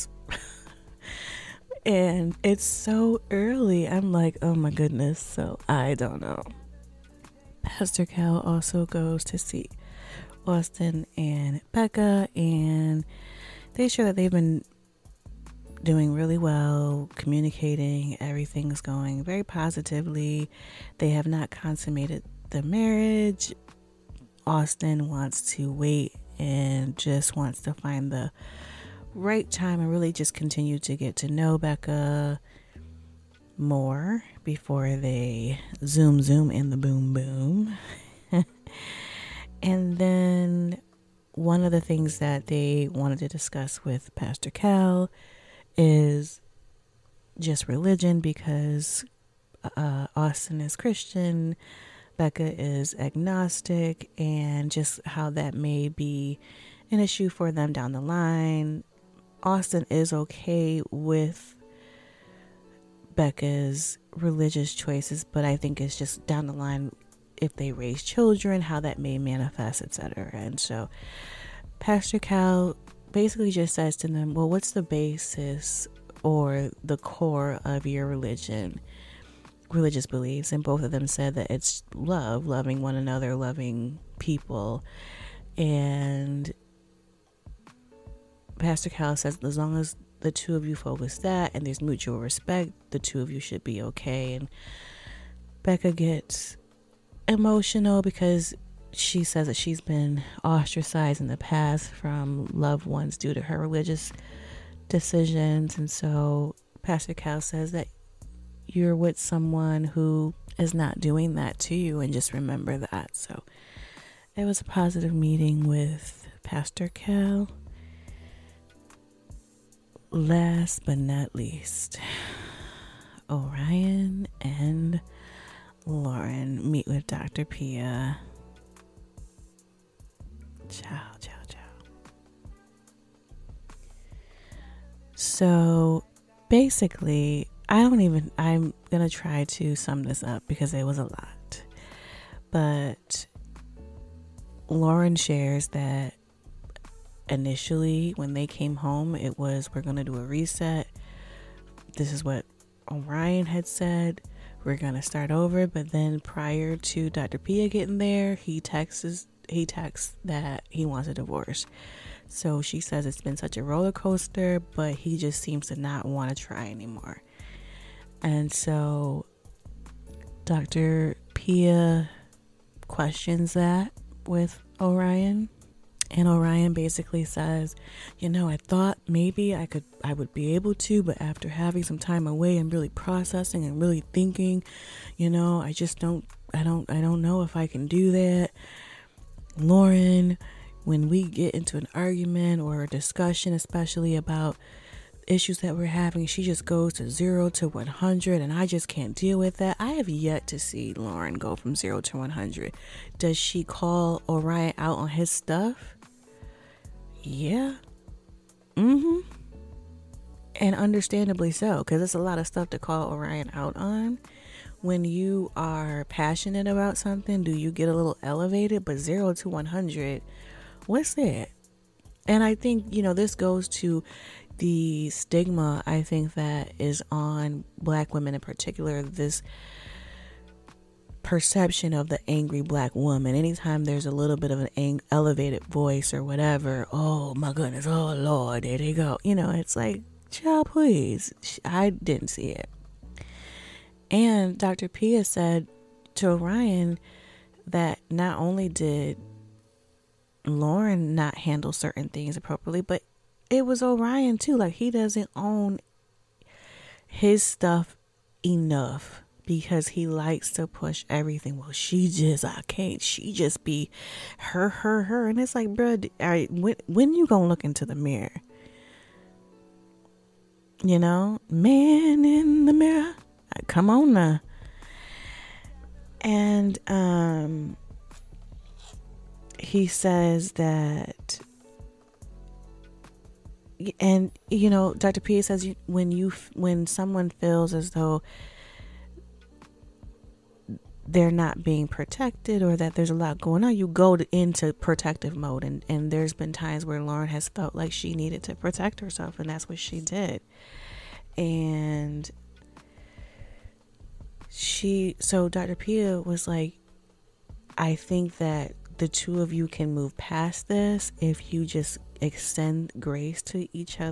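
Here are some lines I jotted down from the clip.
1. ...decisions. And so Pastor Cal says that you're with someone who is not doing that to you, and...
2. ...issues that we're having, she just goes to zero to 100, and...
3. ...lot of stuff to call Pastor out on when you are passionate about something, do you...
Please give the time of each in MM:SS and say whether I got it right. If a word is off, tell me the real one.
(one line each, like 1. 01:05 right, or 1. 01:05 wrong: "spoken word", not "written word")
1. 01:44 right
2. 03:15 right
3. 03:32 wrong: "Orion", not "Pastor".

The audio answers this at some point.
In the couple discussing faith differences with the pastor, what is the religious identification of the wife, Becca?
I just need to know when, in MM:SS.
00:52.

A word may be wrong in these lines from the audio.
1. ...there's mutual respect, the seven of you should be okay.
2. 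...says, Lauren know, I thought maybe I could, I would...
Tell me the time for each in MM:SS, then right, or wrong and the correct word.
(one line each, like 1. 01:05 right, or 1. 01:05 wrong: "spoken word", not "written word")
1. 01:31 wrong: "two", not "seven"
2. 02:57 wrong: "You", not "Lauren".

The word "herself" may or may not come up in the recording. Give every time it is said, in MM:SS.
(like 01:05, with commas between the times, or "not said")
04:58.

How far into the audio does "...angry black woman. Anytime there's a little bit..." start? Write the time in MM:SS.
03:52.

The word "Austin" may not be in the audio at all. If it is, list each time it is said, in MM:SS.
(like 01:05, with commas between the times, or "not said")
00:10, 00:24, 00:50, 00:59.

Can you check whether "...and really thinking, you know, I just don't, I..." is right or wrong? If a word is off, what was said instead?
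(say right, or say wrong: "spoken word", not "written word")
right.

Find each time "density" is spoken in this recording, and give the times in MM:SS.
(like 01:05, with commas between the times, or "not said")
not said.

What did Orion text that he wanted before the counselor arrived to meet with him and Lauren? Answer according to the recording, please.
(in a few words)
A divorce.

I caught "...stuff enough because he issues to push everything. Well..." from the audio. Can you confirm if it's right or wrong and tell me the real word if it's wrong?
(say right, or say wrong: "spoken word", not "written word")
wrong: "likes", not "issues".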